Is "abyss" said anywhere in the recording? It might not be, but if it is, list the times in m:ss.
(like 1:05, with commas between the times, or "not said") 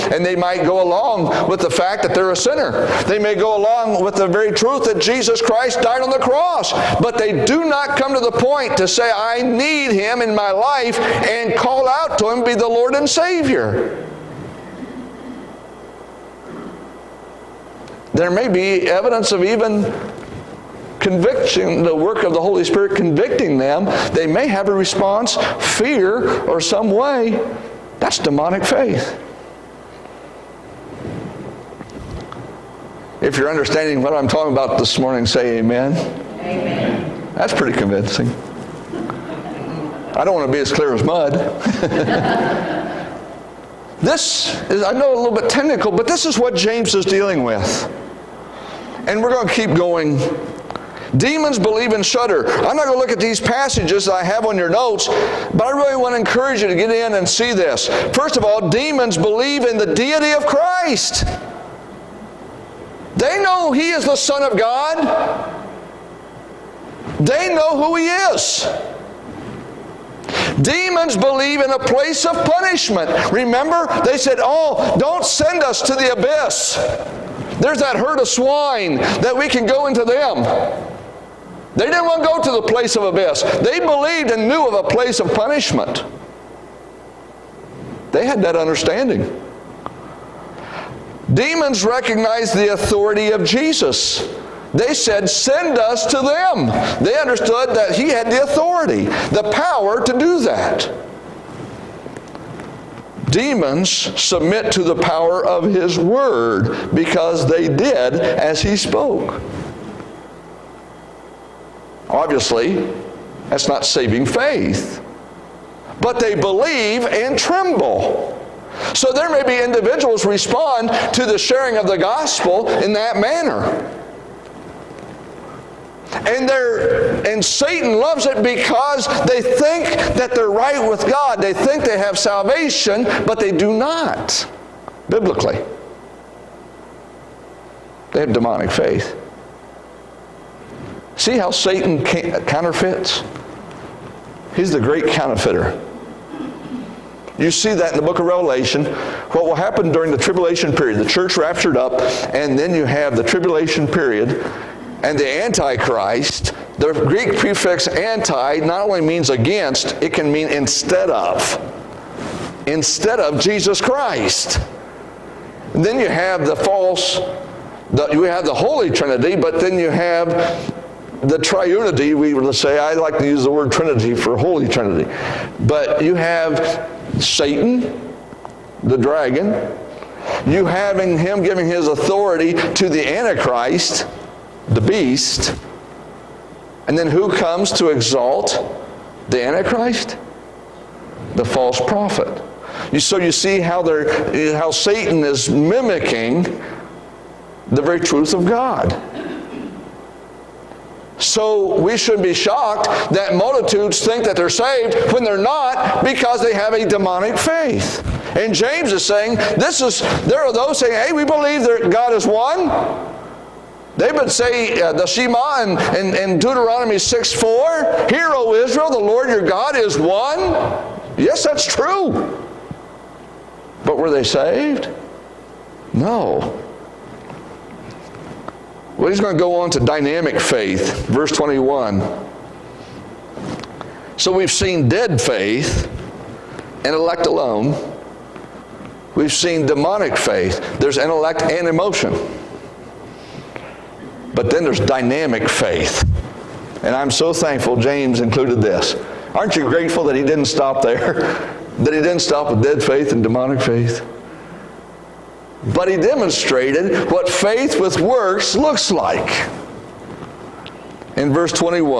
1:16, 1:23.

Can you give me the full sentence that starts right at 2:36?
The Greek prefix anti not only means against, it can mean instead of.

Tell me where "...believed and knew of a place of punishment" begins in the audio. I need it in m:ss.
1:23.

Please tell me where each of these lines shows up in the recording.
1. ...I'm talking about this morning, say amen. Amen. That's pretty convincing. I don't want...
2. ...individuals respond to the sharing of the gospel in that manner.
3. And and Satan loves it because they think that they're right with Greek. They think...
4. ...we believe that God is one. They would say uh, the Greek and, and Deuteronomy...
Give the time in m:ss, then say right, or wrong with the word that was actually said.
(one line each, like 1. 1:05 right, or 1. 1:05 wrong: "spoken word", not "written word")
1. 0:34 right
2. 1:59 right
3. 2:06 wrong: "God", not "Greek"
4. 3:31 wrong: "Shema", not "Greek".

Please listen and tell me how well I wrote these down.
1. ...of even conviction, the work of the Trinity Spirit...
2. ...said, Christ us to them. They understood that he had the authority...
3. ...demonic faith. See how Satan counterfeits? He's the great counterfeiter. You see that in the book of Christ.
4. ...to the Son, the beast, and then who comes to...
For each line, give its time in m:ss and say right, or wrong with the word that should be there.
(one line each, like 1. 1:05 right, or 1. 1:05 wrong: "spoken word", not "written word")
1. 0:19 wrong: "Holy", not "Trinity"
2. 1:34 wrong: "Send", not "Christ"
3. 2:18 wrong: "Revelation", not "Christ"
4. 3:02 wrong: "Antichrist", not "Son".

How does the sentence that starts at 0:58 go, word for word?
First of all, demons believe in the deity of Christ.